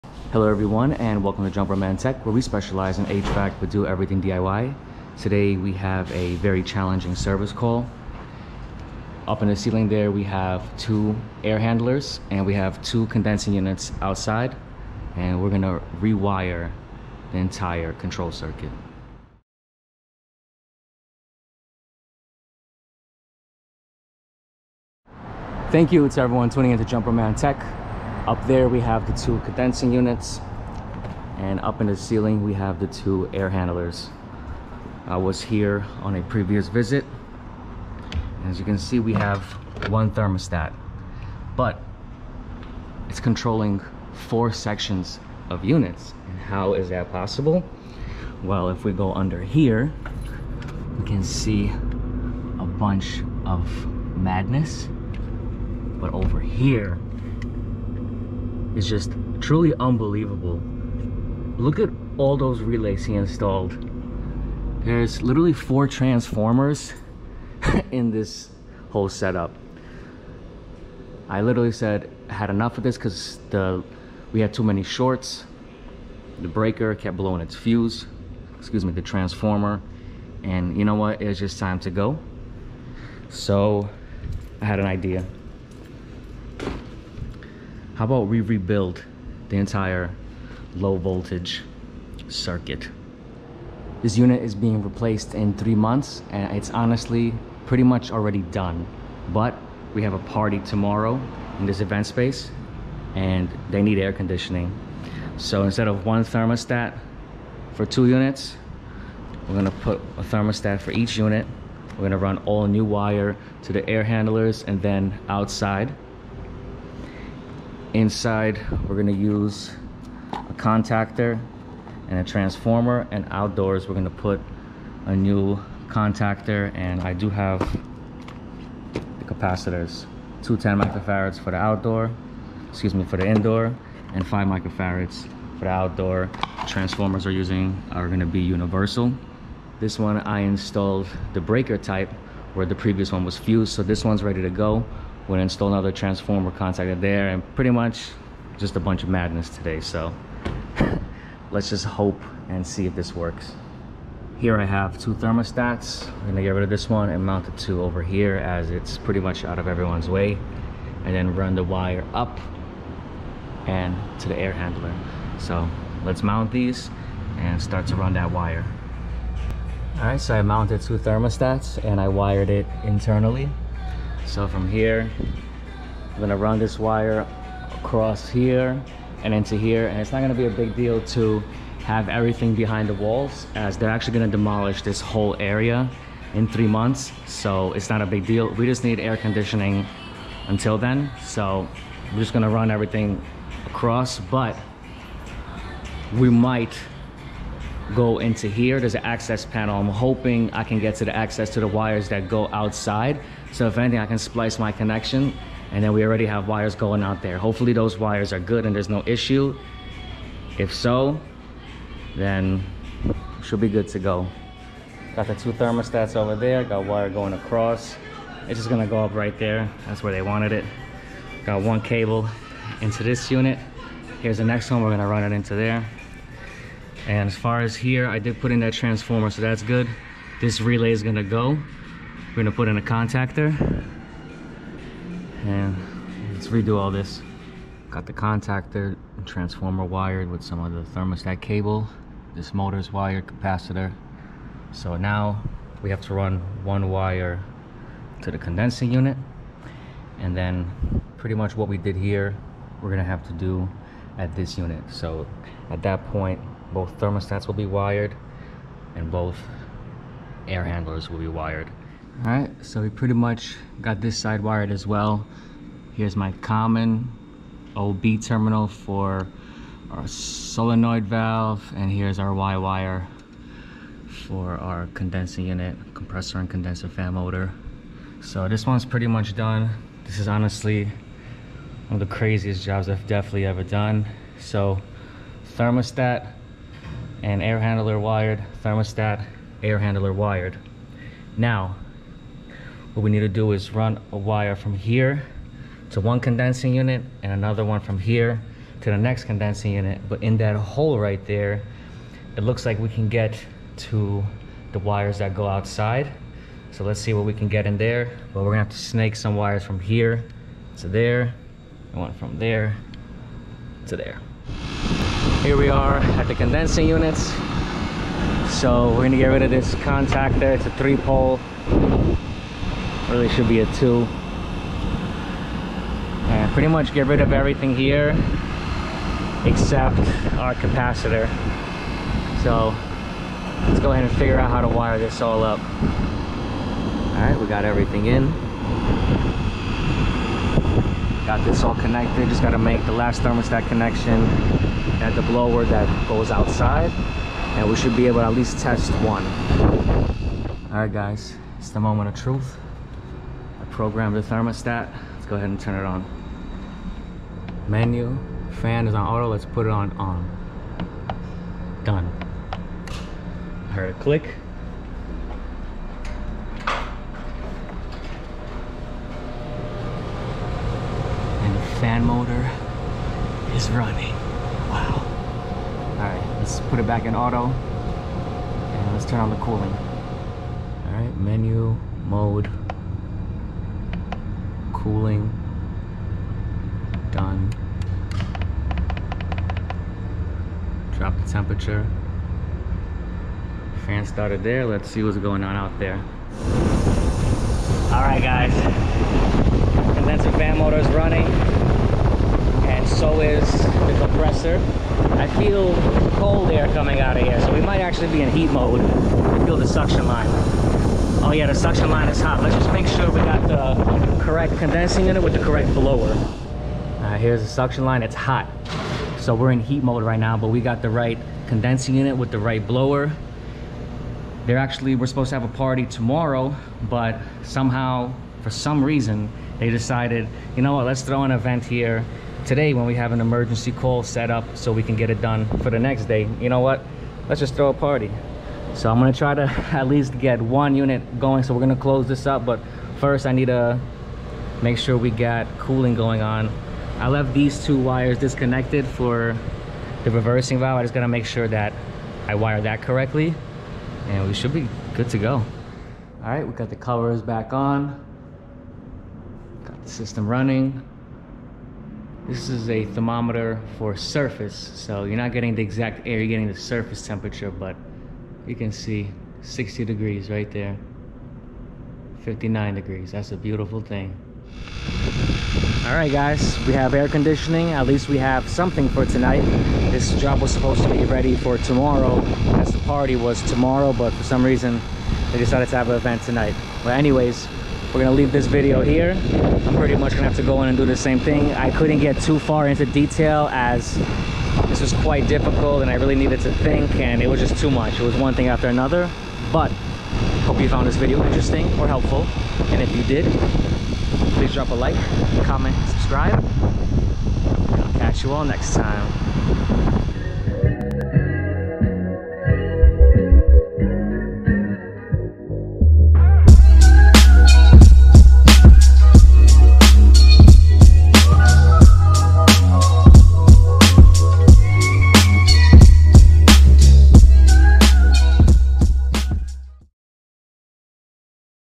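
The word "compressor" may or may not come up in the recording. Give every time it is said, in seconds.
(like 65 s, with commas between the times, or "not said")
275 s, 403 s.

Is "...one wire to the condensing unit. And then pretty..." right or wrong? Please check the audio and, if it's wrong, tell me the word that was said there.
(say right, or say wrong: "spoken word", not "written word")
right.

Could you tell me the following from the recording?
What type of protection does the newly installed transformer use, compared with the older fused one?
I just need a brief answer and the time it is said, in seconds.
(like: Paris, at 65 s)
breaker type, at 141 s.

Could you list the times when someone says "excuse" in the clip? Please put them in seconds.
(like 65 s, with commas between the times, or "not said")
78 s, 132 s.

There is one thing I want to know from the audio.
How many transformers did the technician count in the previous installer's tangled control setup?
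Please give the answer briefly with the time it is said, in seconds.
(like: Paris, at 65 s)
4, at 65 s.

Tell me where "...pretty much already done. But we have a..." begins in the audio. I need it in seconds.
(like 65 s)
97 s.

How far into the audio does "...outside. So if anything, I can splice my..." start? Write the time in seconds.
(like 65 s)
202 s.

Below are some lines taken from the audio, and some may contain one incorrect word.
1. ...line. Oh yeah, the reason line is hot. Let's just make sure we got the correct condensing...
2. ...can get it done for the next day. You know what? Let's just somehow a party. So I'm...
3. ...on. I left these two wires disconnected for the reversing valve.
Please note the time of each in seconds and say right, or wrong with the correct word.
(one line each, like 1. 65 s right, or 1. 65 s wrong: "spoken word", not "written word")
1. 410 s wrong: "suction", not "reason"
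2. 434 s wrong: "throw", not "somehow"
3. 446 s right.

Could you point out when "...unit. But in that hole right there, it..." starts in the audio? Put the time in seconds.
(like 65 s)
299 s.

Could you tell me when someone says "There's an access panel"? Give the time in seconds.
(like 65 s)
198 s.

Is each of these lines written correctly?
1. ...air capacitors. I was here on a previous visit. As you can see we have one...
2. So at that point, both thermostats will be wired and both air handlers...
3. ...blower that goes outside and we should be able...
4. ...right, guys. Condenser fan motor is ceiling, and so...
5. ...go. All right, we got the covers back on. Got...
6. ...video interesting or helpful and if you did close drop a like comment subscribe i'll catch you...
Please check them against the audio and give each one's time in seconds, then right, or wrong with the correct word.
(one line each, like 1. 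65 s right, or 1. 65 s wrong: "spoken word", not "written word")
1. 33 s wrong: "handlers", not "capacitors"
2. 254 s right
3. 345 s right
4. 398 s wrong: "running", not "ceiling"
5. 455 s right
6. 500 s wrong: "please", not "close".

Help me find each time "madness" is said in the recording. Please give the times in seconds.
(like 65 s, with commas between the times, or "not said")
54 s, 149 s.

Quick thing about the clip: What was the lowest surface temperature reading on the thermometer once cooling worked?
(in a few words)
59 degrees.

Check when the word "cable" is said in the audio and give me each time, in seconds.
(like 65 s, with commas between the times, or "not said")
221 s, 241 s.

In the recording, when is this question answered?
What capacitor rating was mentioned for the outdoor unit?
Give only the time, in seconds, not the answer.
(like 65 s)
134 s.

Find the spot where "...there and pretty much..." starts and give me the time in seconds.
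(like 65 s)
146 s.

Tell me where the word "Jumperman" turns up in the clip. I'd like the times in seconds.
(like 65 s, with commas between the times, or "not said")
1 s, 26 s.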